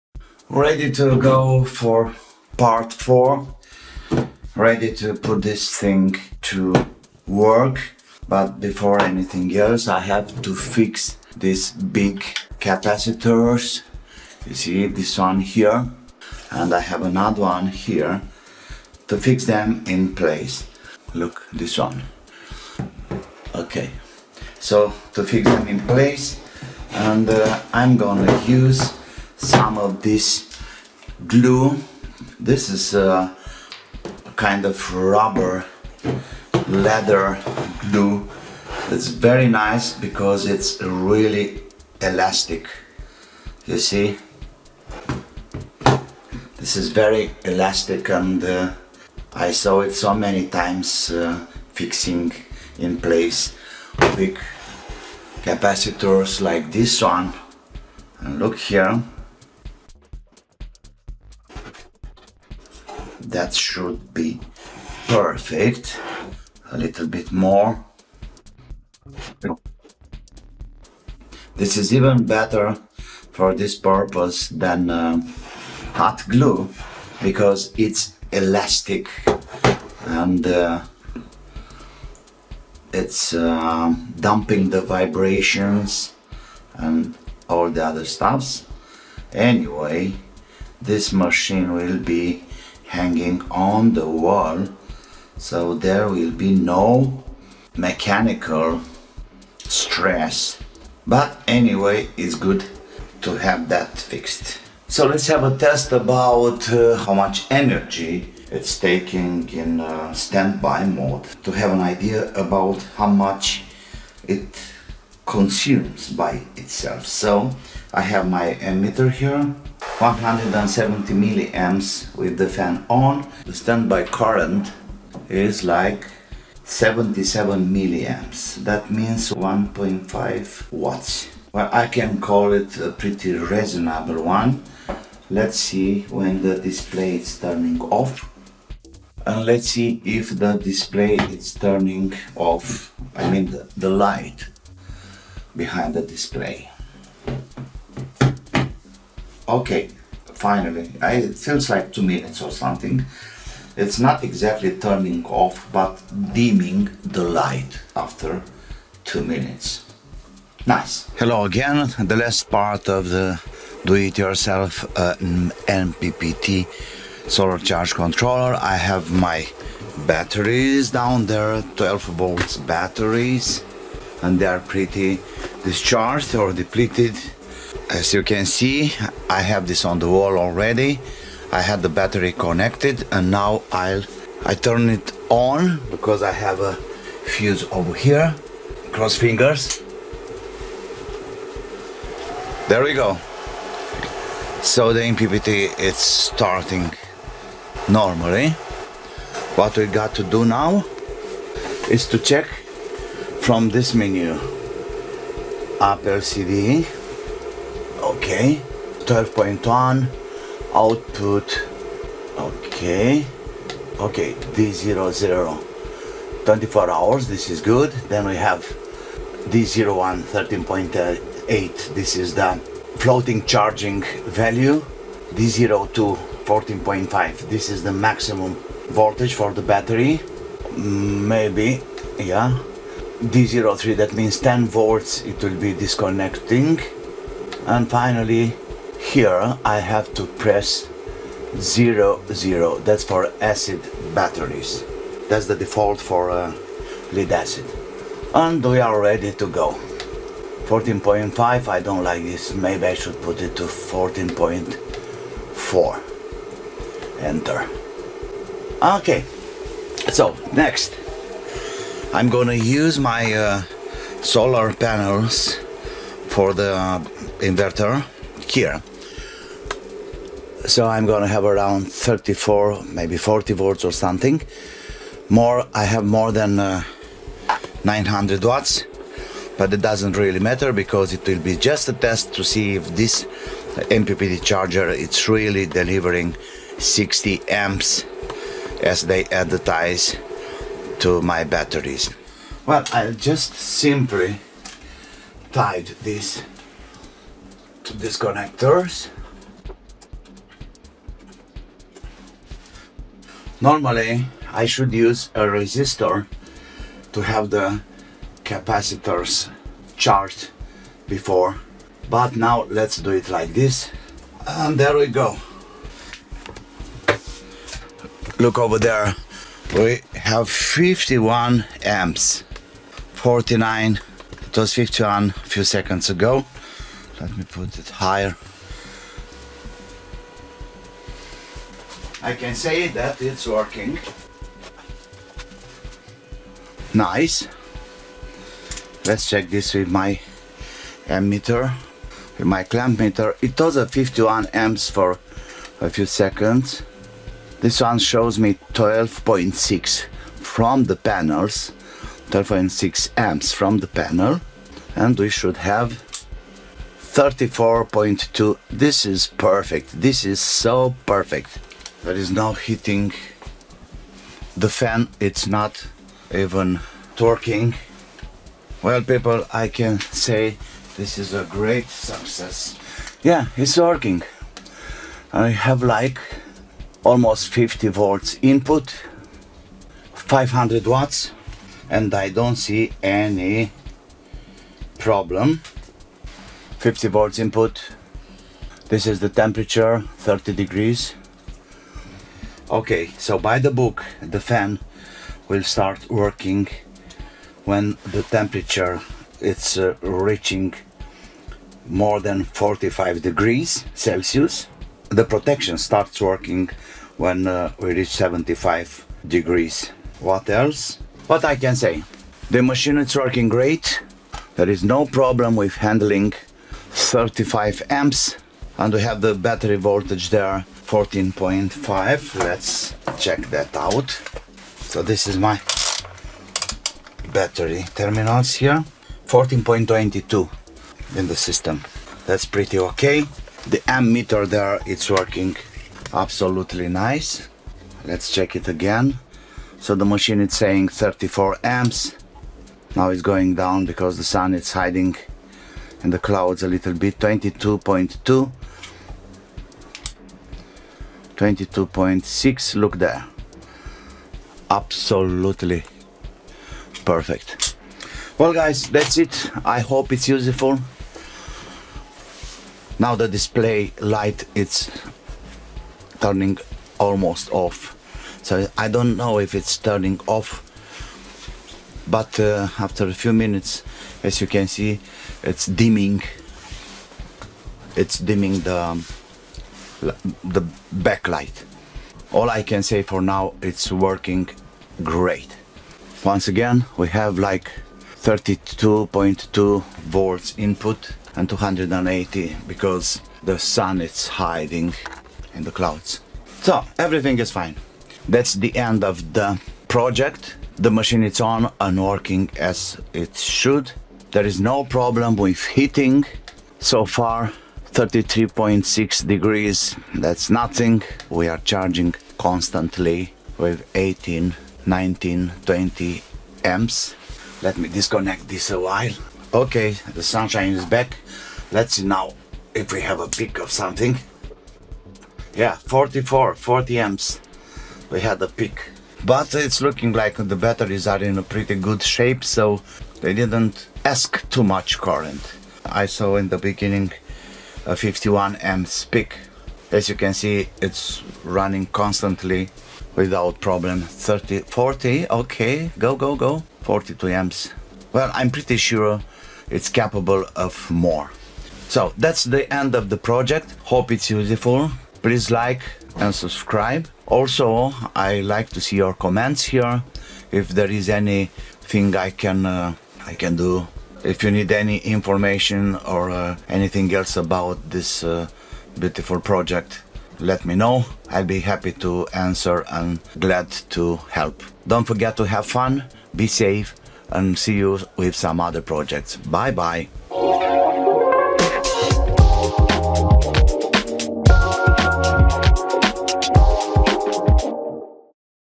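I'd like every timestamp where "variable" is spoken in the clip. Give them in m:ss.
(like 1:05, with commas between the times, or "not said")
not said.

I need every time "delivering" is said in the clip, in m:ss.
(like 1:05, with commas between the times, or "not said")
4:45.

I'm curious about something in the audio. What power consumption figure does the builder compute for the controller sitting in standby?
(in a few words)
1.5 watts.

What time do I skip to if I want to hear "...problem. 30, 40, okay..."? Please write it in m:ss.
9:03.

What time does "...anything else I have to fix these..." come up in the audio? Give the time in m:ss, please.
0:09.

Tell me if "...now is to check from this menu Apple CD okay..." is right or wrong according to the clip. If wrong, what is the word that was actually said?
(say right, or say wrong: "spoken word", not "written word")
right.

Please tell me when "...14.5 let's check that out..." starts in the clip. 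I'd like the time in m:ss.
7:00.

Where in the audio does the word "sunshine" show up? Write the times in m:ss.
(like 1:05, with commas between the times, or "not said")
8:40.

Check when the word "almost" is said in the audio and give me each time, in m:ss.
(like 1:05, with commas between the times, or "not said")
6:17, 7:46.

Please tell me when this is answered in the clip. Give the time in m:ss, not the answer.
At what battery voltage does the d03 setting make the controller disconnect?
3:54.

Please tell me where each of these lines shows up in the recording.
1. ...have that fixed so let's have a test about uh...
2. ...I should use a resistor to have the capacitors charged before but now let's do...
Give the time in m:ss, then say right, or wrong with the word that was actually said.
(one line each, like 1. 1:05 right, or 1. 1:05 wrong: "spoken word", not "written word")
1. 1:43 right
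2. 5:04 right.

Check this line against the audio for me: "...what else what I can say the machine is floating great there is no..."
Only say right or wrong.
wrong.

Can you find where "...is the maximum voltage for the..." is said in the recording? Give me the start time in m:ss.
3:47.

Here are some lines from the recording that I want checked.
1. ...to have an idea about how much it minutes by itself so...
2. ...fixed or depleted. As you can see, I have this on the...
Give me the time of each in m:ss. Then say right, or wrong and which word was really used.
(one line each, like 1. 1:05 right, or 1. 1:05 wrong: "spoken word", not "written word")
1. 1:51 wrong: "consumes", not "minutes"
2. 2:55 wrong: "discharged", not "fixed".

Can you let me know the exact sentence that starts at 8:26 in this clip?
So far, 33.6 degrees, that's nothing.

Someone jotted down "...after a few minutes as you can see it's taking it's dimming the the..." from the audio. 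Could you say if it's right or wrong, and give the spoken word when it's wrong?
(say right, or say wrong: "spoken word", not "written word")
wrong: "dimming", not "taking".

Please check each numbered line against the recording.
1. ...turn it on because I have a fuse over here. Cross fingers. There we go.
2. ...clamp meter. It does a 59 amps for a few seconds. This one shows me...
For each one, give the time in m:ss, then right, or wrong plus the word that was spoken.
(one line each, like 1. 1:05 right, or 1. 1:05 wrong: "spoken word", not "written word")
1. 3:04 right
2. 5:42 wrong: "51", not "59".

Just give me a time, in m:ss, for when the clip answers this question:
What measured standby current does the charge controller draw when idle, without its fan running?
2:06.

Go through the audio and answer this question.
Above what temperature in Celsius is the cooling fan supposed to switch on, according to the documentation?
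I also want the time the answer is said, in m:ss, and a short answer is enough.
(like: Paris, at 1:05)
45 degrees, at 6:42.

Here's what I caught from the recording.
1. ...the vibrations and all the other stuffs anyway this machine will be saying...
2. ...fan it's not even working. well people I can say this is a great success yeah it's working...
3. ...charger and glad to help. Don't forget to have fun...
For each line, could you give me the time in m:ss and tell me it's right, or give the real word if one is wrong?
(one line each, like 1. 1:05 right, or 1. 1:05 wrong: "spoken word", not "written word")
1. 1:24 wrong: "hanging", not "saying"
2. 6:04 right
3. 9:32 wrong: "answer", not "charger".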